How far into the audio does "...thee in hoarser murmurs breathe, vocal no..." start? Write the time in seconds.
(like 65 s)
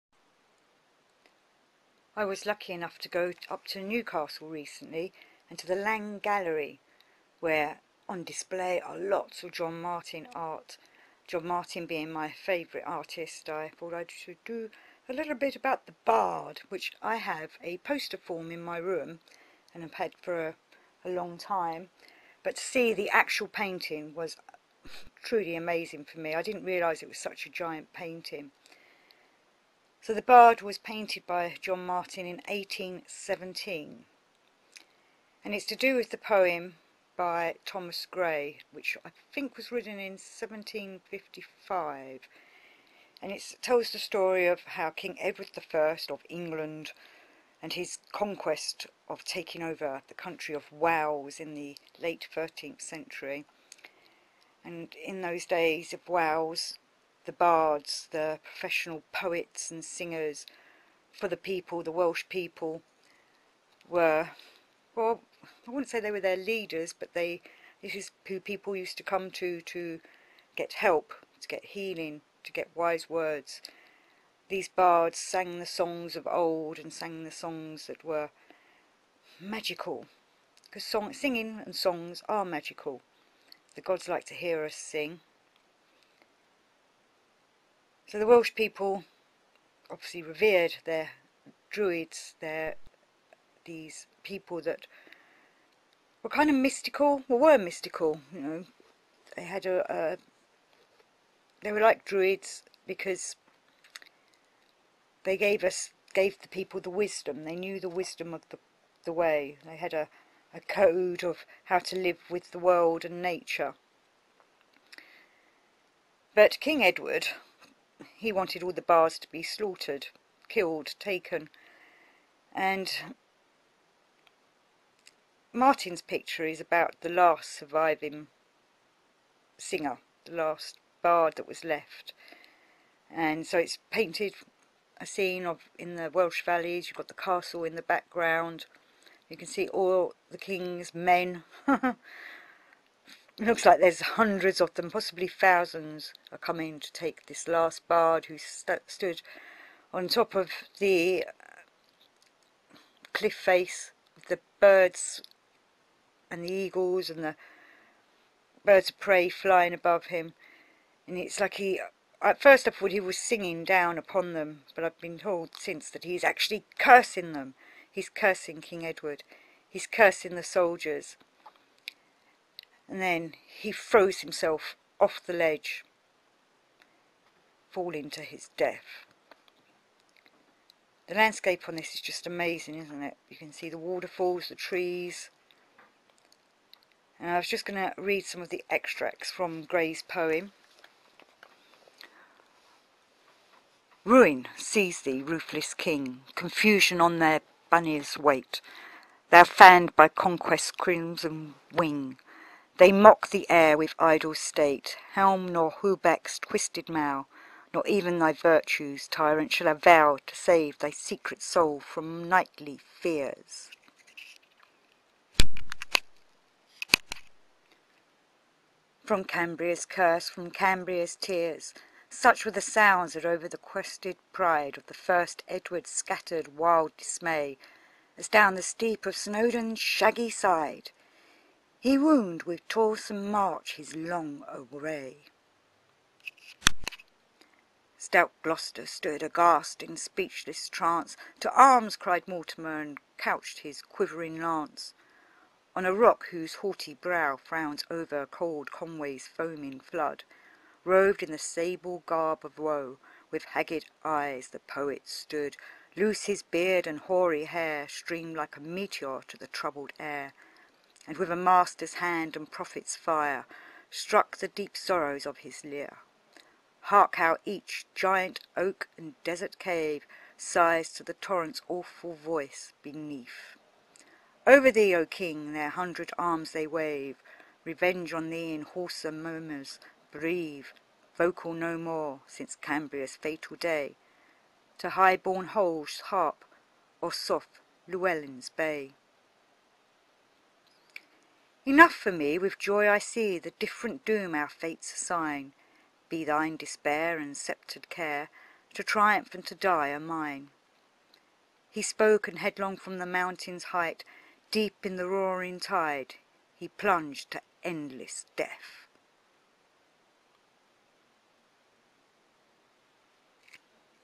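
278 s.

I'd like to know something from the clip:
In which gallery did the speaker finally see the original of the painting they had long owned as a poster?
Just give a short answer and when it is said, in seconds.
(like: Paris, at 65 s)
Laing Gallery, at 5 s.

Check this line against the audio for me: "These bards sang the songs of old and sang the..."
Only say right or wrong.
right.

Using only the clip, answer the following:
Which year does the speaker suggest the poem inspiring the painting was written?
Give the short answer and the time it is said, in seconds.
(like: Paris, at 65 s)
1755, at 40 s.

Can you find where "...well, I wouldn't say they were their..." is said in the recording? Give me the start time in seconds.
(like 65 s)
64 s.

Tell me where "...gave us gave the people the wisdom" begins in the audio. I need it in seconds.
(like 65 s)
105 s.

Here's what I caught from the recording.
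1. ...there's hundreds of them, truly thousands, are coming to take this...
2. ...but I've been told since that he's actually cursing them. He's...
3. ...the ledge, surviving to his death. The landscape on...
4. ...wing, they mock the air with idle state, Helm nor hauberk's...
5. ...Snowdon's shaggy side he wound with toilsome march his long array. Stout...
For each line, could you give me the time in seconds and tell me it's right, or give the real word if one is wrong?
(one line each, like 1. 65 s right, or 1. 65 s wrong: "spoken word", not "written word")
1. 143 s wrong: "possibly", not "truly"
2. 164 s right
3. 175 s wrong: "falling", not "surviving"
4. 201 s right
5. 229 s right.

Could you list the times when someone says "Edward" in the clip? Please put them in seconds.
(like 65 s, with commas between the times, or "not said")
45 s, 116 s, 168 s, 225 s.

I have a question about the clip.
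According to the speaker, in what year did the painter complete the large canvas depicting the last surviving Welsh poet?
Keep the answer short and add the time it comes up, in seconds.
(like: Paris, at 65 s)
1817, at 32 s.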